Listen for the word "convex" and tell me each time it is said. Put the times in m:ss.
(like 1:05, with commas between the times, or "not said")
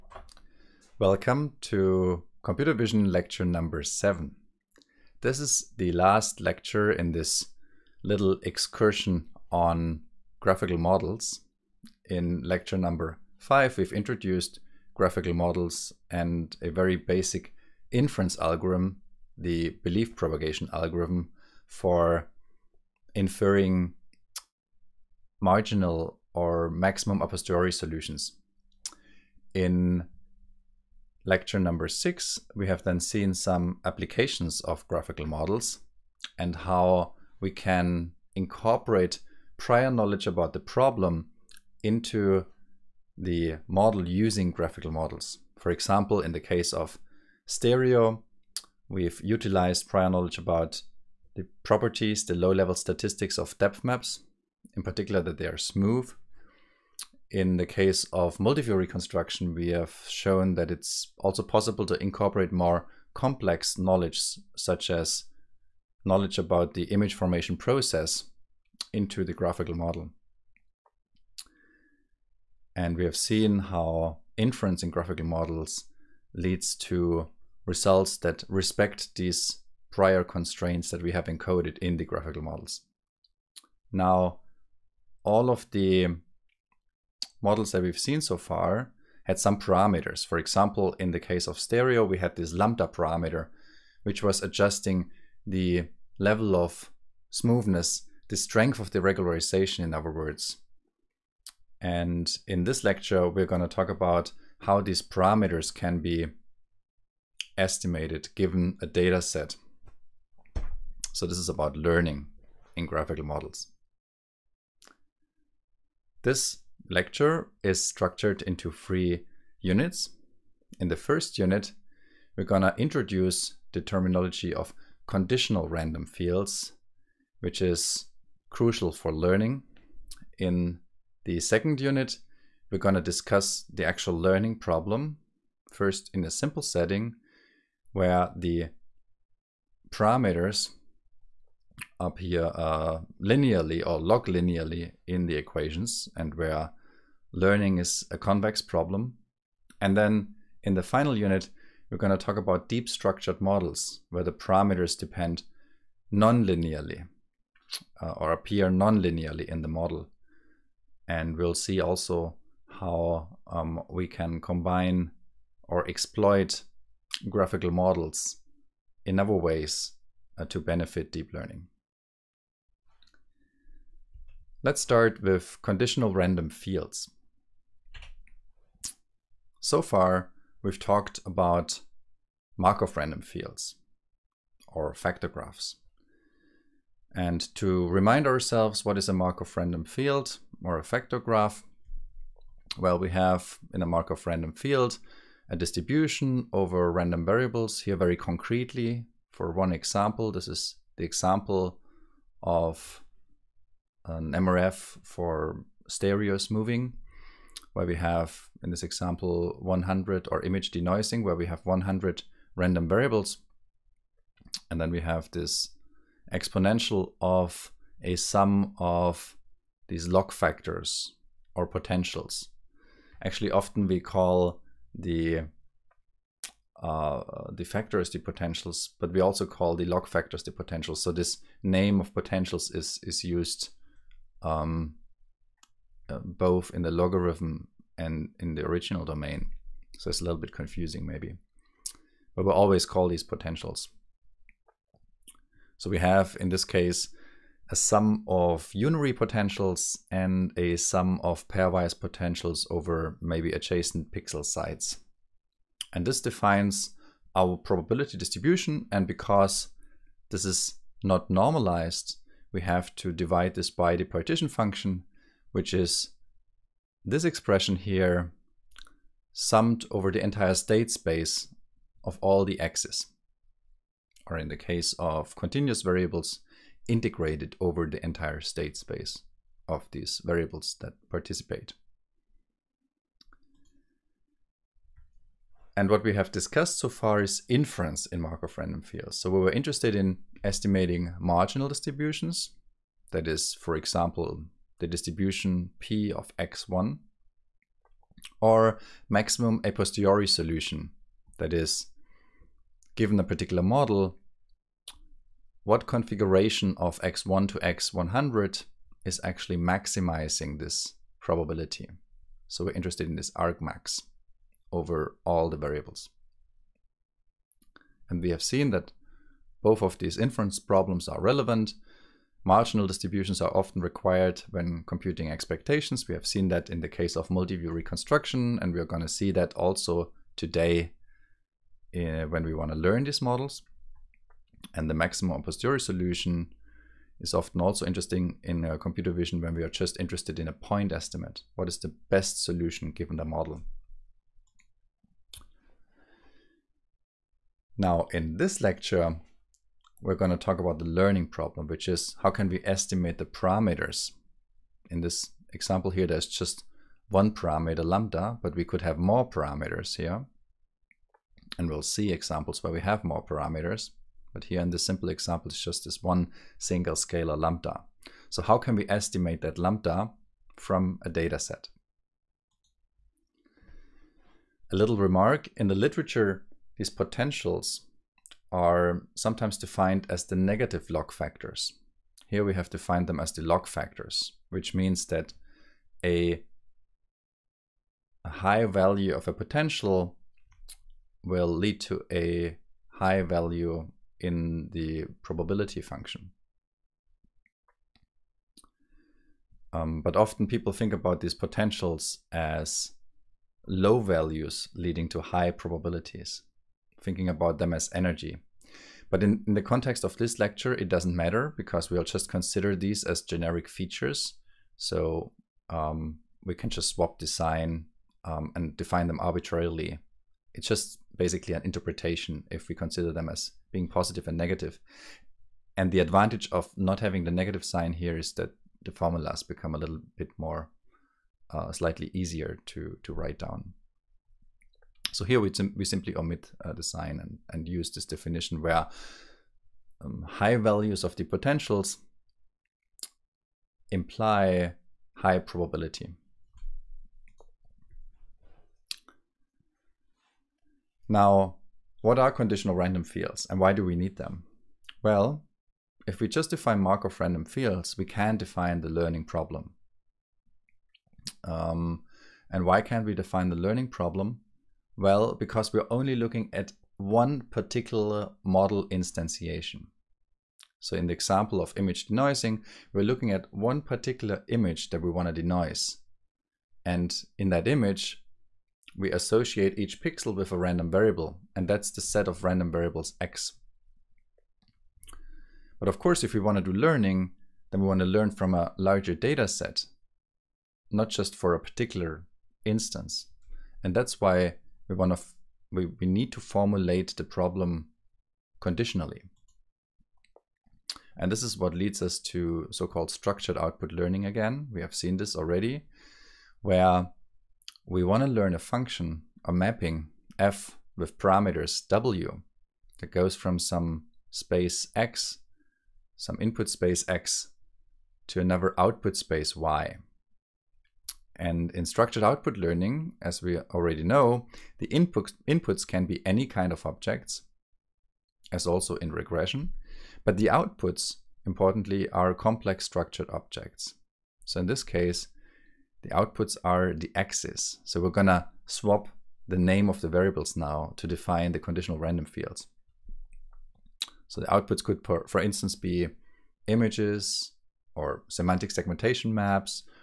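2:28.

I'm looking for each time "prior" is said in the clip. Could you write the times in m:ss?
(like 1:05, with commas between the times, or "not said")
0:39, 0:49, 1:19.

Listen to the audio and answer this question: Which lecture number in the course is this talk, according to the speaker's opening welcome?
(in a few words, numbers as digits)
7.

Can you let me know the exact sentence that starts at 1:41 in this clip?
And in this lecture, we're going to talk about how these parameters can be estimated given a data set.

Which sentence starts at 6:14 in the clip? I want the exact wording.
A little remark, in the literature, these potentials are sometimes defined as the negative log factors.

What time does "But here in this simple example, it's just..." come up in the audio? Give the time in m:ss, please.
6:04.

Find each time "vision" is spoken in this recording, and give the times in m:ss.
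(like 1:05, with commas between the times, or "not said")
0:02, 5:39.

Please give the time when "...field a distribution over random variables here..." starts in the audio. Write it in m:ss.
3:14.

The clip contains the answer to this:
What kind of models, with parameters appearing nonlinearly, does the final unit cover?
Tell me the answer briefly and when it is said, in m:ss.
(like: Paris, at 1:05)
Deep structured models, at 2:32.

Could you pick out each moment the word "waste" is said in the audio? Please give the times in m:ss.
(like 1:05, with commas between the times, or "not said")
not said.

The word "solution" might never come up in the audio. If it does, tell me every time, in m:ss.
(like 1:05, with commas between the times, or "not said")
0:27, 5:00, 5:35, 5:42.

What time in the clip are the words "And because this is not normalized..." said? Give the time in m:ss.
4:18.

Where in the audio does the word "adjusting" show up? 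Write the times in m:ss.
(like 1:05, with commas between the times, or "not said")
1:34.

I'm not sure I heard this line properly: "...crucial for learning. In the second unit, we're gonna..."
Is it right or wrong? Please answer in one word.
right.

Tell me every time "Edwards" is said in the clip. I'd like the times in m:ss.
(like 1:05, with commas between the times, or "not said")
not said.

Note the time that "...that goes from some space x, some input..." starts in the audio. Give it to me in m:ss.
8:32.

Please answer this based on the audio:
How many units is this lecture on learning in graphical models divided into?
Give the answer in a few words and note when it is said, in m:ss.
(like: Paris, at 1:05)
3, at 1:58.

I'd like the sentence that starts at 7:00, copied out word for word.
It's just basically an interpretation if we consider them as being positive and negative.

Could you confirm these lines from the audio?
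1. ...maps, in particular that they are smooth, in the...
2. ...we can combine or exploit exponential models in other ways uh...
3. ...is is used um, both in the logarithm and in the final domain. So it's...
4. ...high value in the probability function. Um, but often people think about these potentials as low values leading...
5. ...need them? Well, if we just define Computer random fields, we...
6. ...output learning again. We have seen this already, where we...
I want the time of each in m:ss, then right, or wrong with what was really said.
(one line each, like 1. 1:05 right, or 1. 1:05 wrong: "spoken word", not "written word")
1. 0:53 right
2. 2:43 wrong: "graphical", not "exponential"
3. 3:52 wrong: "original", not "final"
4. 6:32 right
5. 7:33 wrong: "Markov", not "Computer"
6. 8:23 right.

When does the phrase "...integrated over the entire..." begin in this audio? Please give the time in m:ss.
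4:36.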